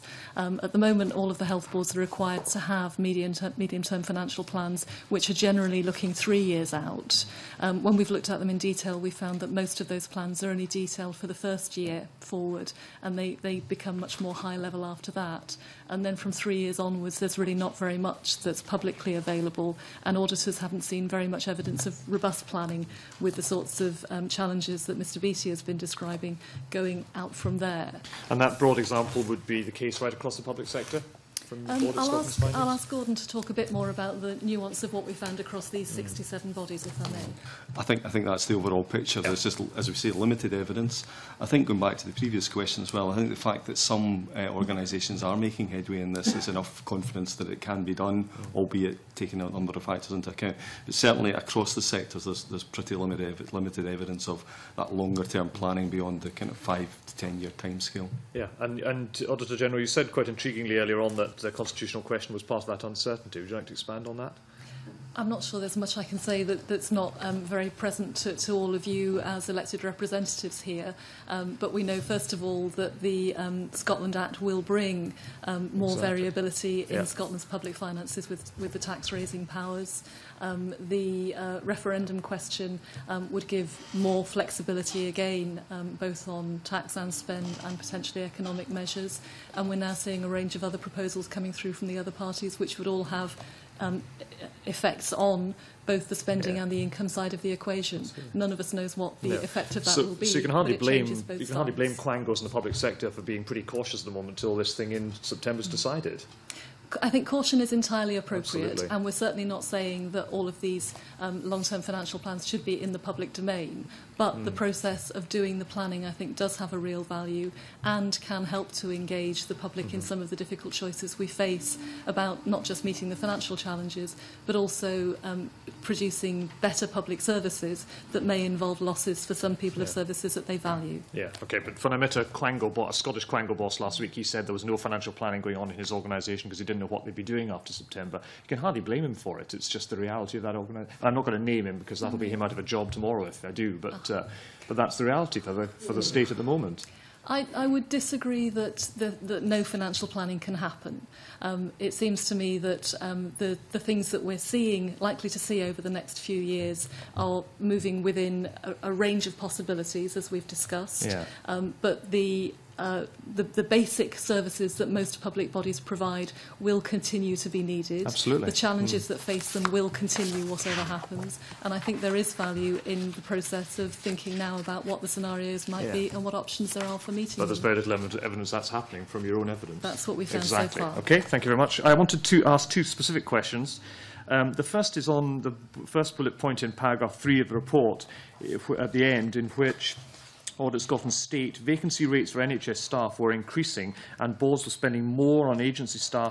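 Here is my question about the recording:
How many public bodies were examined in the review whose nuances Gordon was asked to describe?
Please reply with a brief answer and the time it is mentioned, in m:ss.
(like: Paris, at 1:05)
67, at 0:35.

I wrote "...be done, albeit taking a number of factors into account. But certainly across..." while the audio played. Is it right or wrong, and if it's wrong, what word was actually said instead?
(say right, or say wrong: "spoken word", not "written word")
right.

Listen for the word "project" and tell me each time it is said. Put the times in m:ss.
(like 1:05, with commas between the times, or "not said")
not said.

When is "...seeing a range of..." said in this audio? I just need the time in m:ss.
1:29.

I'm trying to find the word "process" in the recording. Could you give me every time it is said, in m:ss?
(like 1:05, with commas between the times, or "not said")
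1:54, 2:53.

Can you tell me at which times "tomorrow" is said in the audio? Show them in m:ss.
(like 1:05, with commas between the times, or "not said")
2:22.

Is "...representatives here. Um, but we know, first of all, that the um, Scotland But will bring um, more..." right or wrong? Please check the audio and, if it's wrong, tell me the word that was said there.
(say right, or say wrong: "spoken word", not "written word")
wrong: "Act", not "But".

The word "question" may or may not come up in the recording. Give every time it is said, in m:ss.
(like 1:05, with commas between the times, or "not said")
0:42, 1:02, 1:22, 3:03.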